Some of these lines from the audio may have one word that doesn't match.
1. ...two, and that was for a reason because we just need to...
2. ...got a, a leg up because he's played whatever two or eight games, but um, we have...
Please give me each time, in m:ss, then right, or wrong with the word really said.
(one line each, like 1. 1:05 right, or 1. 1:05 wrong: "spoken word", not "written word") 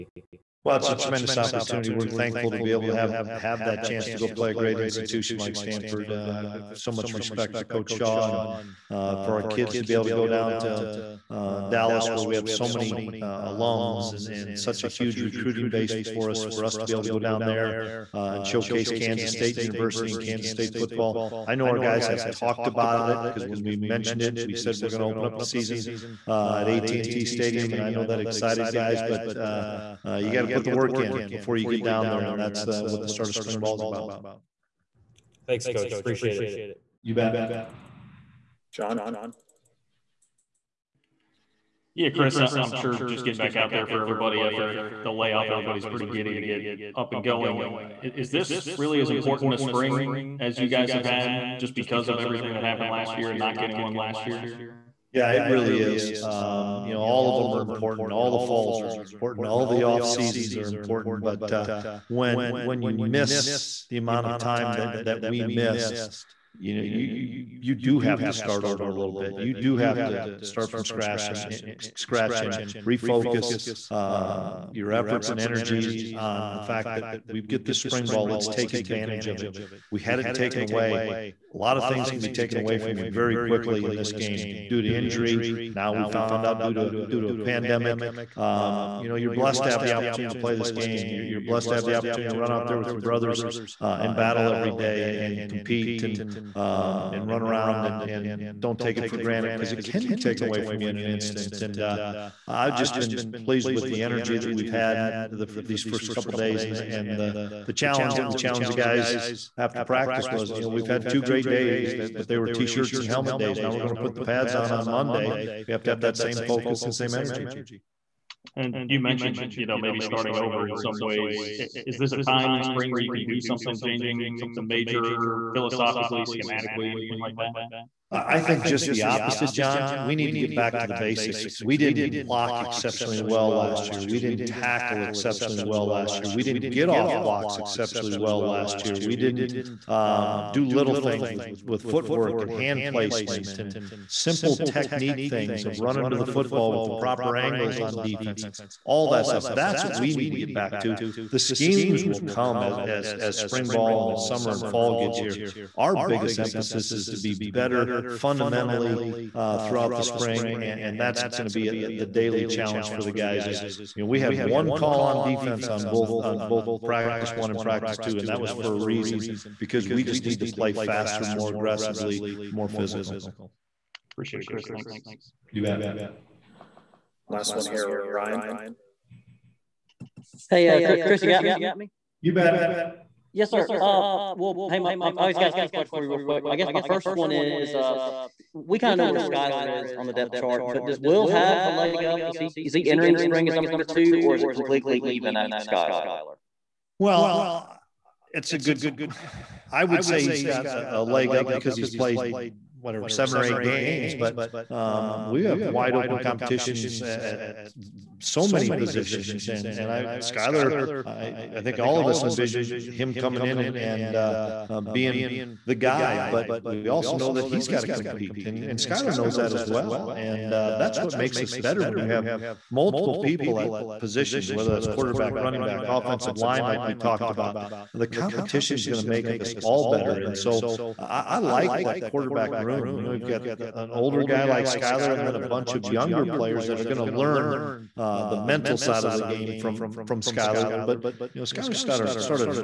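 1. 2:47 right
2. 3:20 wrong: "seven", not "two".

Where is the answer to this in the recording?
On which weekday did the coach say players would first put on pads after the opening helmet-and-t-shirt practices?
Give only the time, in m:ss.
1:54.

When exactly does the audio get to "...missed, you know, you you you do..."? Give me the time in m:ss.
1:05.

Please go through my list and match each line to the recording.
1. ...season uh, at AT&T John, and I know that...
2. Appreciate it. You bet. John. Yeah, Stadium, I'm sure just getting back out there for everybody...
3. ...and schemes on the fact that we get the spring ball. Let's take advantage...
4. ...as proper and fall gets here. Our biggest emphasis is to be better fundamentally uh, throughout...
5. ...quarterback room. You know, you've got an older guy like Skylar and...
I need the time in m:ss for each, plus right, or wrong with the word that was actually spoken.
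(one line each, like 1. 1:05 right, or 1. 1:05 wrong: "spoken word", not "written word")
1. 0:25 wrong: "Stadium", not "John"
2. 0:35 wrong: "Chris", not "Stadium"
3. 1:15 wrong: "energies", not "schemes"
4. 2:34 wrong: "summer", not "proper"
5. 3:52 right.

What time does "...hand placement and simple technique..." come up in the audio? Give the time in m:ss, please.
2:22.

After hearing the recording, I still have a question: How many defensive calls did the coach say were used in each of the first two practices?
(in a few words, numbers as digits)
1.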